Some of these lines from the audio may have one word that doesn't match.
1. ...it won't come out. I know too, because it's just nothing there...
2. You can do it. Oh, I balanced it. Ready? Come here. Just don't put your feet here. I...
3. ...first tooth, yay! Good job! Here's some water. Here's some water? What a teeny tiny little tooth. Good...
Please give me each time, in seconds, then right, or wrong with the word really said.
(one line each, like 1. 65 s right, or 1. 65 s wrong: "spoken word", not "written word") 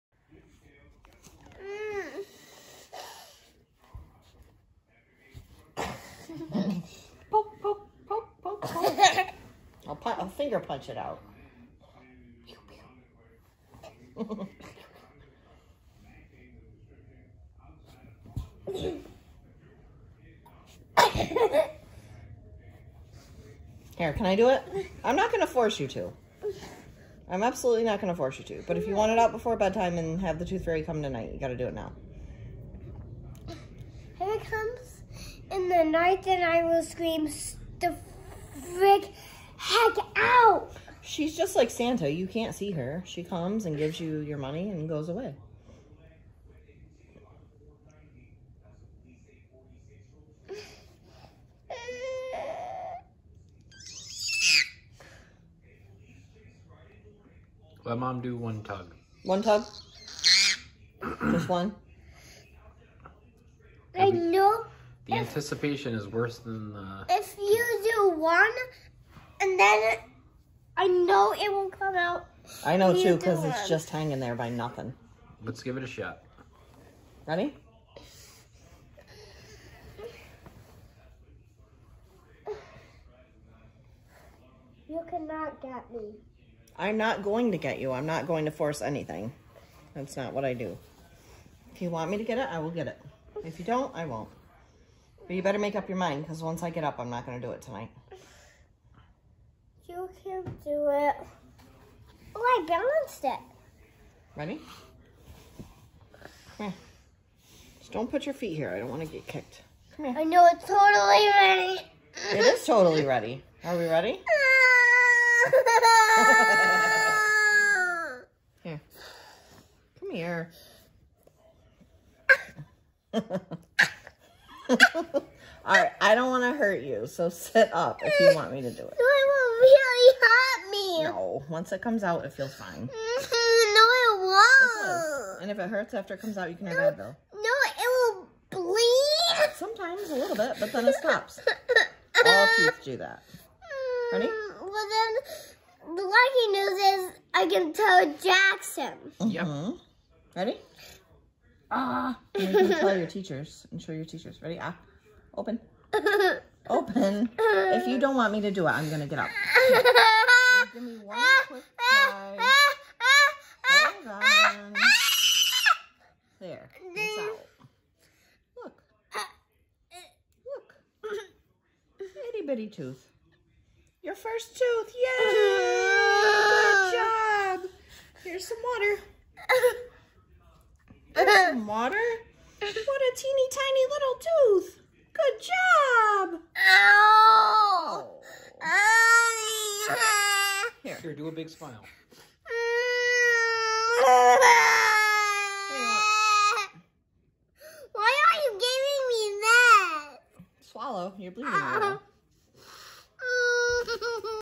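1. 71 s wrong: "hanging", not "nothing"
2. 99 s right
3. 174 s right.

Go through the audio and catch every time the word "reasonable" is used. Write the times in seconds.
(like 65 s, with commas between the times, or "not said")
not said.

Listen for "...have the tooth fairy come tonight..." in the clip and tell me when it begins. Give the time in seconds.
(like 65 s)
30 s.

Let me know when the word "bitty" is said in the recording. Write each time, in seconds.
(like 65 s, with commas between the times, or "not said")
172 s.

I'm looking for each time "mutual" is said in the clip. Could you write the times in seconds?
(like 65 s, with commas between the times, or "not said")
not said.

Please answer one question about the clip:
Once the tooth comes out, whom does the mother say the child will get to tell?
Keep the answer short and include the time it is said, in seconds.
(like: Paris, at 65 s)
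Jackson, at 148 s.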